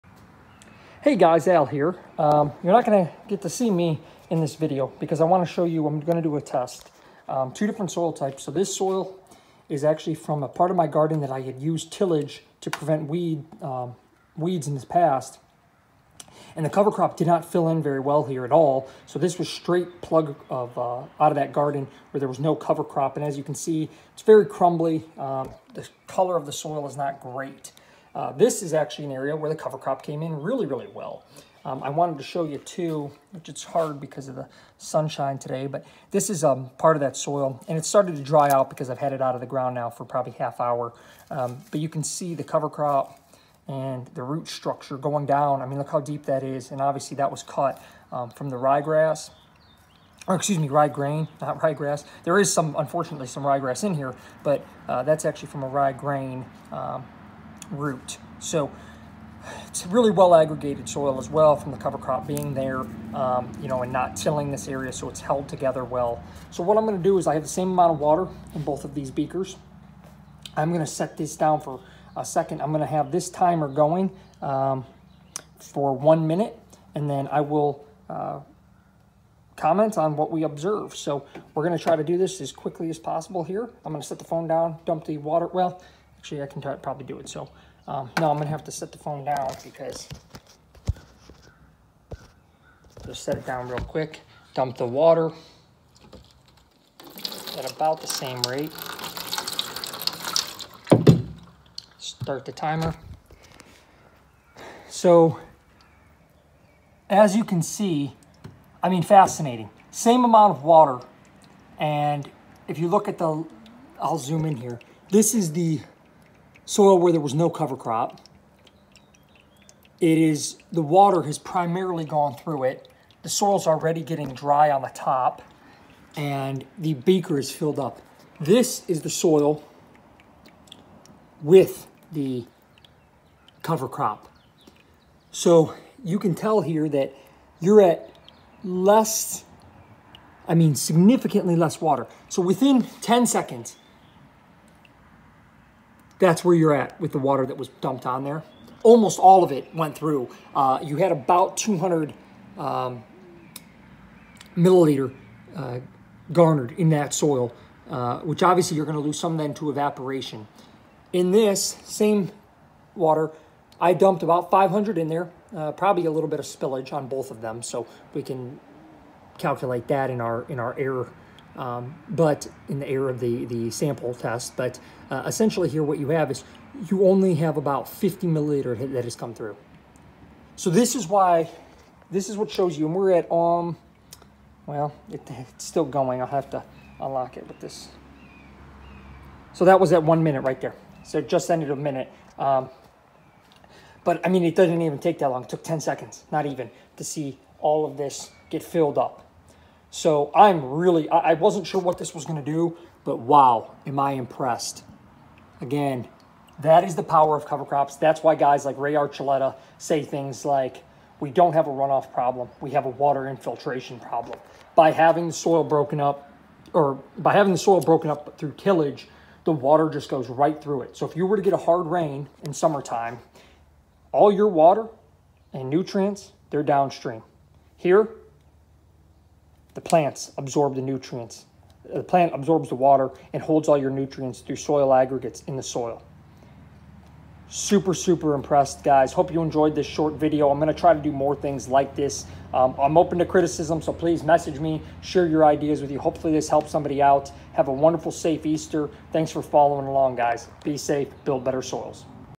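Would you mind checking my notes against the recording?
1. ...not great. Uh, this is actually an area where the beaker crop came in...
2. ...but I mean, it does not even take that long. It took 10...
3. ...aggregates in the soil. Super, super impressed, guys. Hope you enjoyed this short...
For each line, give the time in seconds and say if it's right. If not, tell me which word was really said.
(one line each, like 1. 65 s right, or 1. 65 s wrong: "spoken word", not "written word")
1. 26 s wrong: "cover", not "beaker"
2. 194 s right
3. 234 s right.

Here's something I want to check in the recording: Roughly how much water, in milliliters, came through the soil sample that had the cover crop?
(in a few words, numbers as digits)
50 milliliters.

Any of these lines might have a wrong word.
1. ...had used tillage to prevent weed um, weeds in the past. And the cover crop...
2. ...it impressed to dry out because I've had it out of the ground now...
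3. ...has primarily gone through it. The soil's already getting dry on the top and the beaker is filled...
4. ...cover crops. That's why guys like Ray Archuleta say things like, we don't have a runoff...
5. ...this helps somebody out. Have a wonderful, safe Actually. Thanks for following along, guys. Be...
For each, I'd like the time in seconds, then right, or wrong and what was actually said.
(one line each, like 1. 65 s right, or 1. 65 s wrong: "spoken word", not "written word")
1. 11 s right
2. 37 s wrong: "started", not "impressed"
3. 121 s right
4. 207 s right
5. 246 s wrong: "Easter", not "Actually".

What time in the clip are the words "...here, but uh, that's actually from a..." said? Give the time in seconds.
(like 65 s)
53 s.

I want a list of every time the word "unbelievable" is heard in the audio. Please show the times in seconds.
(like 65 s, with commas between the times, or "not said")
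not said.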